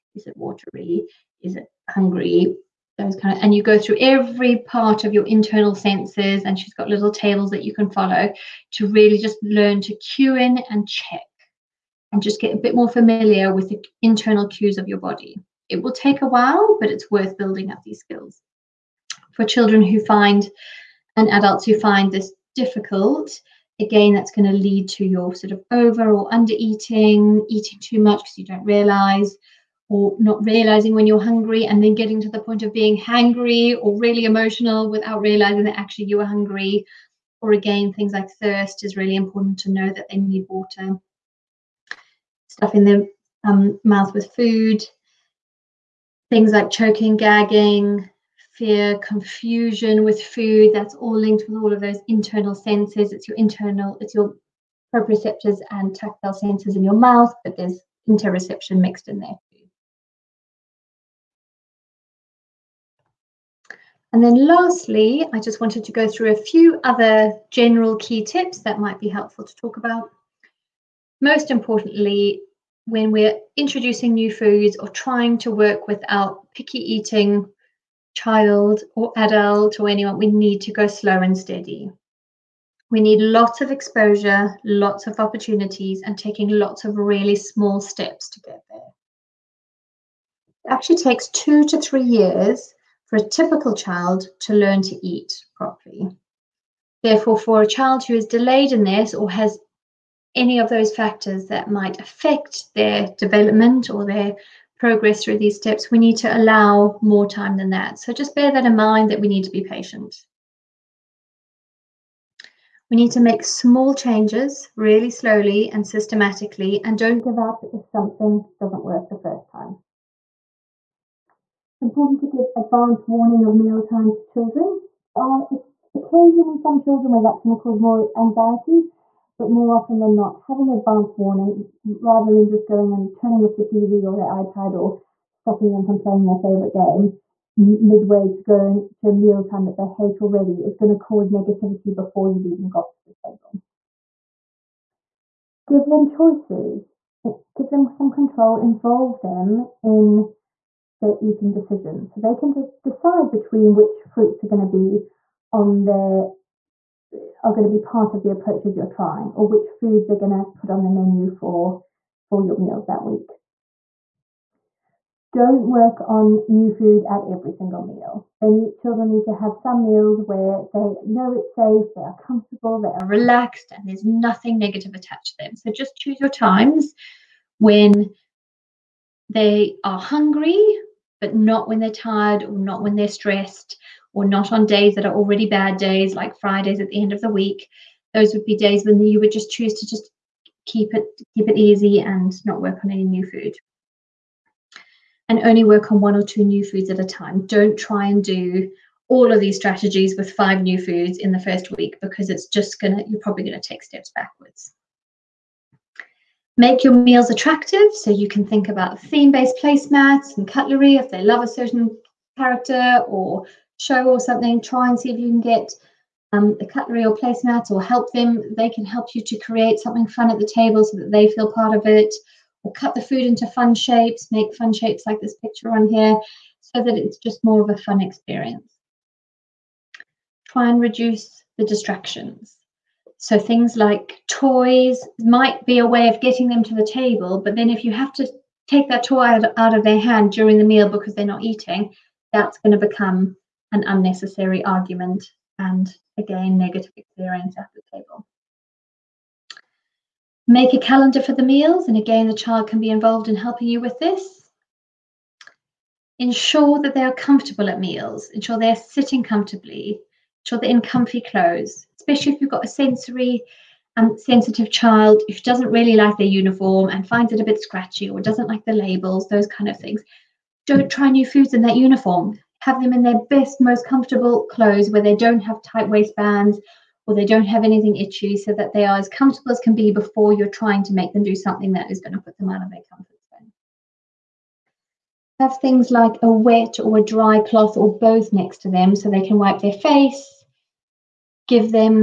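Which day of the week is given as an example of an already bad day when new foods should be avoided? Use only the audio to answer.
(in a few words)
Fridays.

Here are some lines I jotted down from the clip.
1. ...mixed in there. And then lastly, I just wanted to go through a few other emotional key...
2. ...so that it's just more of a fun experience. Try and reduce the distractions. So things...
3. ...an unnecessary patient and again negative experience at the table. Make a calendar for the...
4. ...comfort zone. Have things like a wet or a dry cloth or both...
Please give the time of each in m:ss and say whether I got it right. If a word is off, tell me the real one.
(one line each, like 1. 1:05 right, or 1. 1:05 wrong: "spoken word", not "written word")
1. 0:58 wrong: "general", not "emotional"
2. 3:46 right
3. 4:03 wrong: "argument", not "patient"
4. 4:42 right.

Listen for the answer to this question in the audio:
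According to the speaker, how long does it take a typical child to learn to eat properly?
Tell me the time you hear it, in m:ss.
1:31.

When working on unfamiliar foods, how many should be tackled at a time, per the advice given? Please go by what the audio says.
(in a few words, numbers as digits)
1 or 2.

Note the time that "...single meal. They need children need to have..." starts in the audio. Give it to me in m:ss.
2:47.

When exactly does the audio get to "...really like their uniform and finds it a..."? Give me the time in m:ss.
4:25.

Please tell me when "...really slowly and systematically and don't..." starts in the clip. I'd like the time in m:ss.
1:54.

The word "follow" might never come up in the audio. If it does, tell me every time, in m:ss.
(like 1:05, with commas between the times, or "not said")
0:07.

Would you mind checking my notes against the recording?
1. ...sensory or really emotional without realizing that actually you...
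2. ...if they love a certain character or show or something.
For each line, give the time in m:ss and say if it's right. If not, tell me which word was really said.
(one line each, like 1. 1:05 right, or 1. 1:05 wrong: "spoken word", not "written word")
1. 0:32 wrong: "hangry", not "sensory"
2. 3:30 right.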